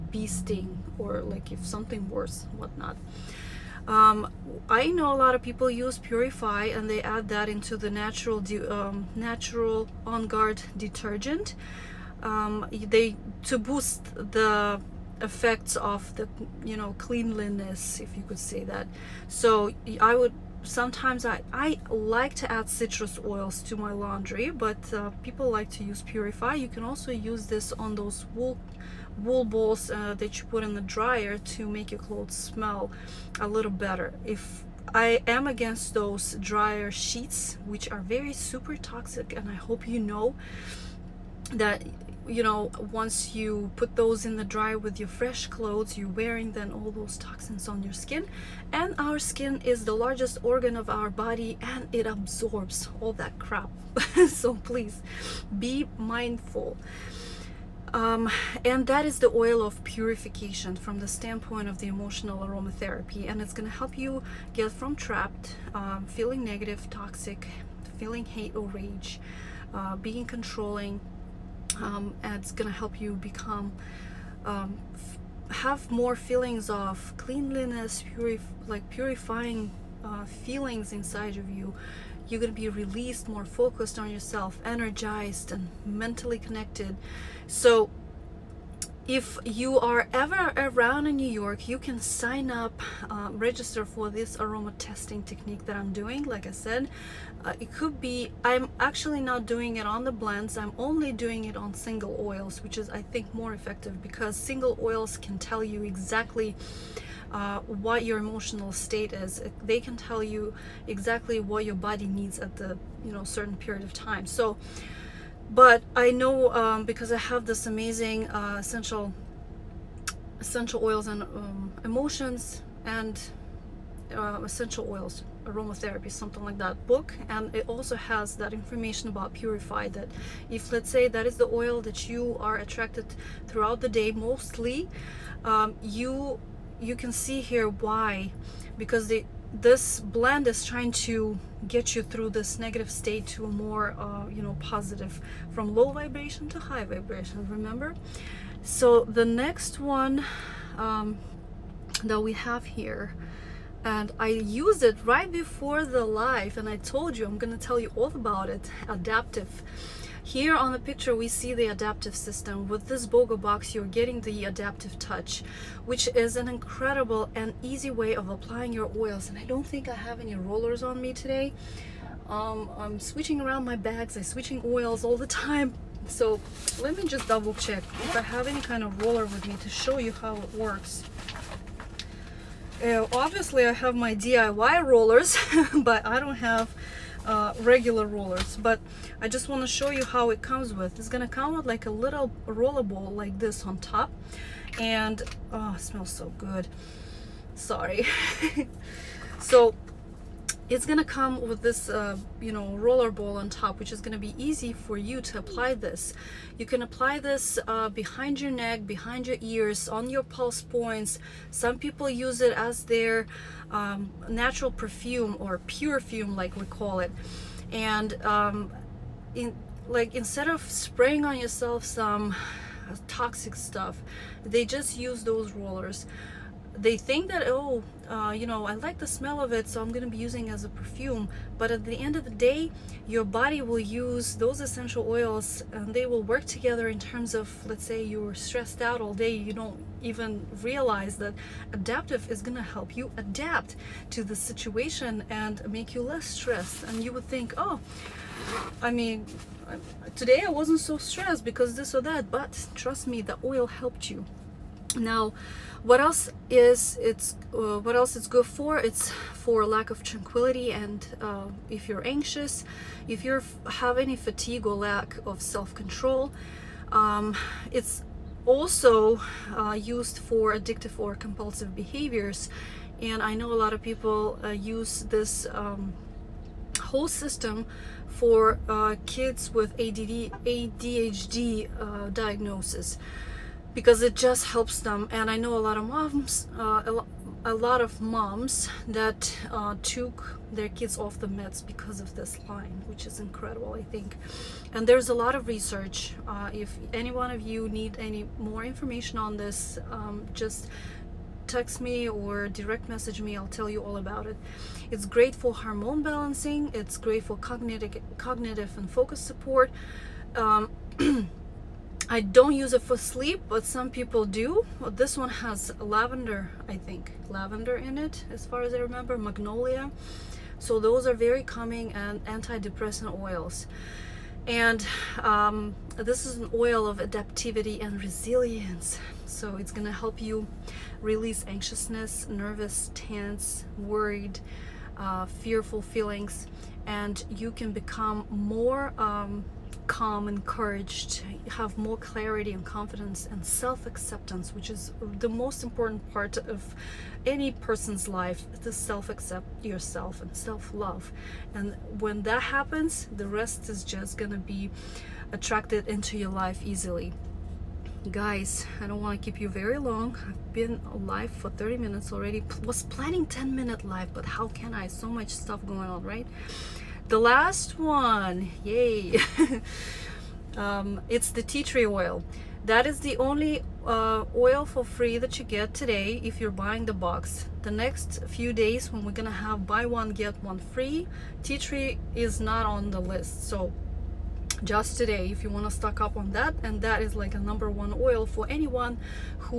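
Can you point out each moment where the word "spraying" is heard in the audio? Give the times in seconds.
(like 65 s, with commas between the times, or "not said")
220 s.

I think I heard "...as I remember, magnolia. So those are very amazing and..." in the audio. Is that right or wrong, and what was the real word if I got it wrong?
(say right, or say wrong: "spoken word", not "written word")
wrong: "calming", not "amazing".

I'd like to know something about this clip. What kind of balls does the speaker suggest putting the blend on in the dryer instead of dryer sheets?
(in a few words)
wool balls.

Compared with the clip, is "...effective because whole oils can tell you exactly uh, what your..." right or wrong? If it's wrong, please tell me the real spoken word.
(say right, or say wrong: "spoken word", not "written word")
wrong: "single", not "whole".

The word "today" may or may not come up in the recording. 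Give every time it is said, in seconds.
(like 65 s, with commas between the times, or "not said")
171 s, 250 s, 375 s, 384 s.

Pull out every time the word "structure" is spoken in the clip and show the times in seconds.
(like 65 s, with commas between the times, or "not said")
not said.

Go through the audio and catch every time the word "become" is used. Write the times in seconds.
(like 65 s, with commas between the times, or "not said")
73 s, 337 s.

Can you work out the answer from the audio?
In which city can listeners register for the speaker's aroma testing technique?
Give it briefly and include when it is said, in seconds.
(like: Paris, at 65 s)
New York, at 91 s.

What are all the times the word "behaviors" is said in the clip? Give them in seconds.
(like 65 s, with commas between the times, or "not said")
271 s.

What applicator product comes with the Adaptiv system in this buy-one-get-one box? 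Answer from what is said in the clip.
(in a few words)
Adaptiv touch.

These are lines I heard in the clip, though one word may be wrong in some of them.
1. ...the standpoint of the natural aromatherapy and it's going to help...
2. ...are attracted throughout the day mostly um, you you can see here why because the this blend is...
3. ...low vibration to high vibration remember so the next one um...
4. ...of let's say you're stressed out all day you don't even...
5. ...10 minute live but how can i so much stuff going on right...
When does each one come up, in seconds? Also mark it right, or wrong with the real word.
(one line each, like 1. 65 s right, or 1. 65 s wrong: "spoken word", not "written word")
1. 61 s wrong: "emotional", not "natural"
2. 132 s right
3. 145 s right
4. 237 s right
5. 363 s right.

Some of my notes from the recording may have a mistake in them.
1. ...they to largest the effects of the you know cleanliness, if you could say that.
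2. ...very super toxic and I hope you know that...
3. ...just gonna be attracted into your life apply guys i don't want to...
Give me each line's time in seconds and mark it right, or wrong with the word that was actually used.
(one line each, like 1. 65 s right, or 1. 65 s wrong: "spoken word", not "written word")
1. 12 s wrong: "boost", not "largest"
2. 38 s right
3. 353 s wrong: "easily", not "apply".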